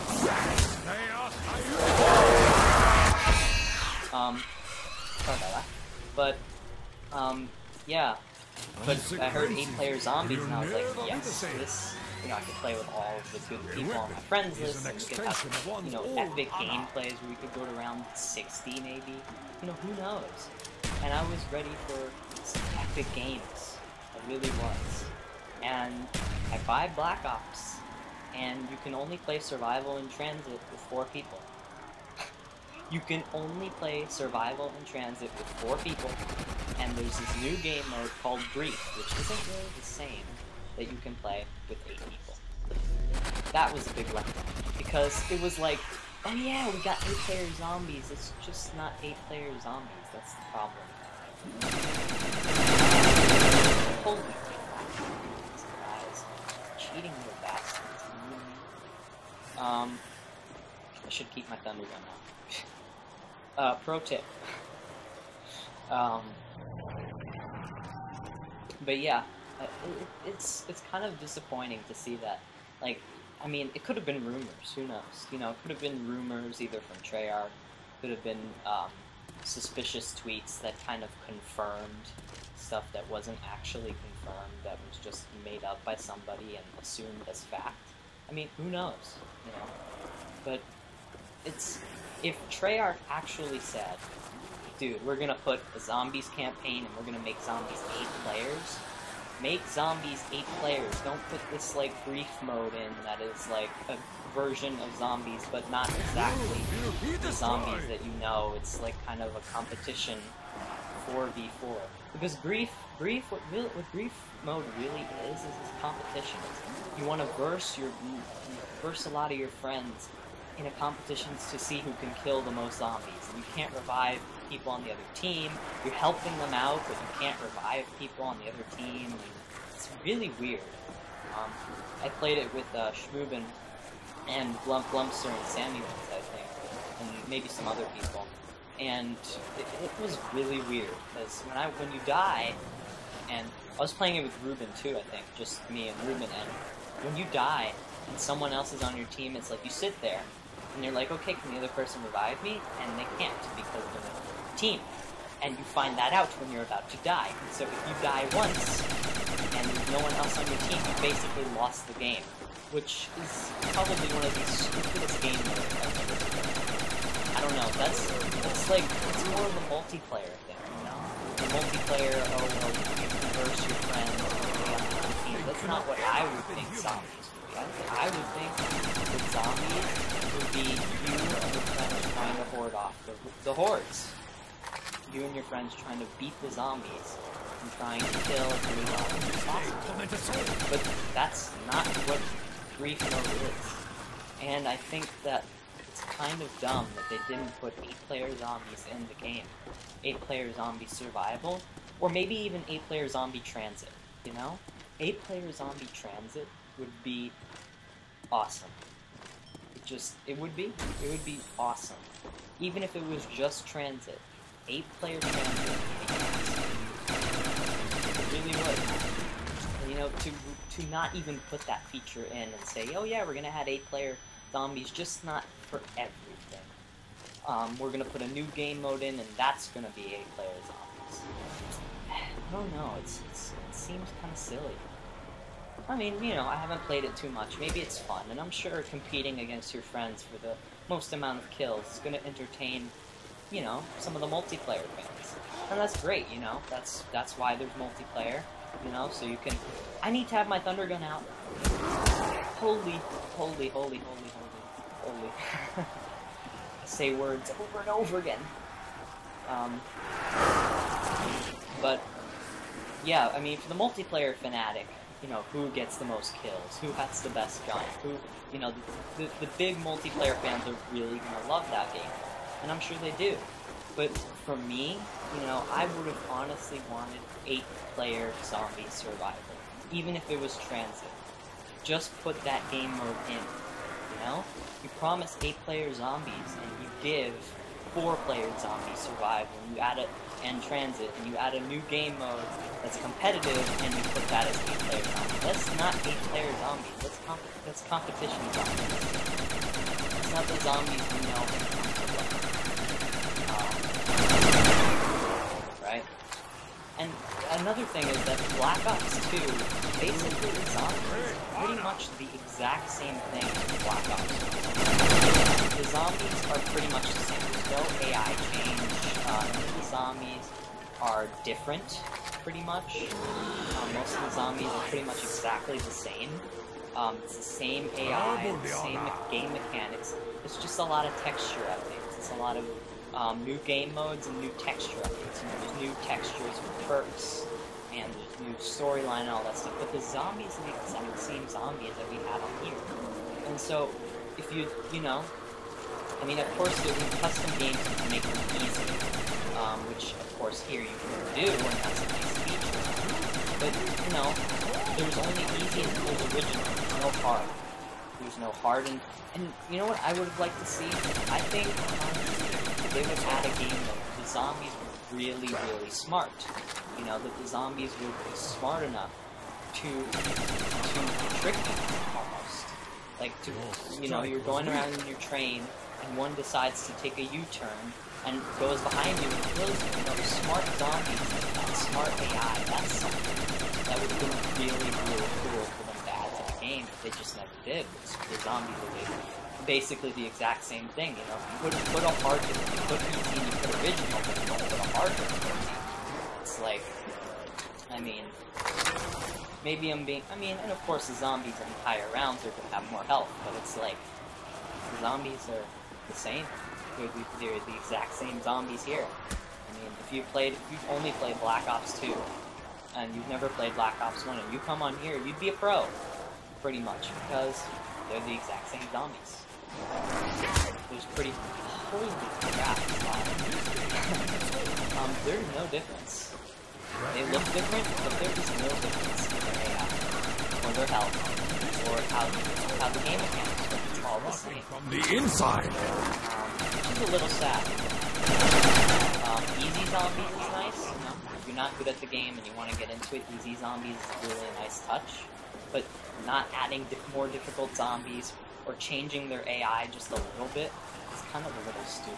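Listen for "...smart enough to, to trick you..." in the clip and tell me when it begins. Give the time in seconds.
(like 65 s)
368 s.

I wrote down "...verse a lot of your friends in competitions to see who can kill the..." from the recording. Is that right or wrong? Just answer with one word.
right.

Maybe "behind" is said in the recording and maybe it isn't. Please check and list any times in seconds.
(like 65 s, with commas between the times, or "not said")
378 s.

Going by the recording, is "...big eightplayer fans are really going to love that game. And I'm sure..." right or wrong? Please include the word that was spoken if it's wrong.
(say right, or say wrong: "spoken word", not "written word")
wrong: "multiplayer", not "eightplayer".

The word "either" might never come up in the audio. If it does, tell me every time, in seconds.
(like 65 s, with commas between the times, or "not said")
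76 s.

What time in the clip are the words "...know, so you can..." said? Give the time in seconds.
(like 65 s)
248 s.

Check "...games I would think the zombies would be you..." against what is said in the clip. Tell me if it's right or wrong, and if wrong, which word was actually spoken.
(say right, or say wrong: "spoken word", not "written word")
wrong: "zombies", not "games".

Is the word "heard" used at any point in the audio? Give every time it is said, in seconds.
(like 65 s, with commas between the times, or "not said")
9 s.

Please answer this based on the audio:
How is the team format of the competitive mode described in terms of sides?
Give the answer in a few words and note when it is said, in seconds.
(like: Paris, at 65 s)
four v four, at 111 s.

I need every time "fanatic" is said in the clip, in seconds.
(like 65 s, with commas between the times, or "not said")
264 s.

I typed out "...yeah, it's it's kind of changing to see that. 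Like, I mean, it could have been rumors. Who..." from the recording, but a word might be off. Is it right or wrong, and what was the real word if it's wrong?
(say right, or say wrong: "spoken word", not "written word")
wrong: "disappointing", not "changing".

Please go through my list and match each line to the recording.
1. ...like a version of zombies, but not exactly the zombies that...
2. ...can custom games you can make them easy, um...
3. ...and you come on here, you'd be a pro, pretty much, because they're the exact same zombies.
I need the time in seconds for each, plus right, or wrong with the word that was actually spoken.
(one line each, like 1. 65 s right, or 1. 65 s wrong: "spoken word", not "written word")
1. 103 s right
2. 346 s right
3. 414 s right.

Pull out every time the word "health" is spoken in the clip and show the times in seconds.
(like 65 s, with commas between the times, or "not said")
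403 s, 430 s.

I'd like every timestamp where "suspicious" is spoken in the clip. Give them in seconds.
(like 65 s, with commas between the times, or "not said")
79 s.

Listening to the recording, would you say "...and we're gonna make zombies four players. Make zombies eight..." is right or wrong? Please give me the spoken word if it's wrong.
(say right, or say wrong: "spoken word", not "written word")
wrong: "eight", not "four".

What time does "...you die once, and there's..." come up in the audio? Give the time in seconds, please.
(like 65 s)
157 s.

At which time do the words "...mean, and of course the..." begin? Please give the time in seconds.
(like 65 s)
400 s.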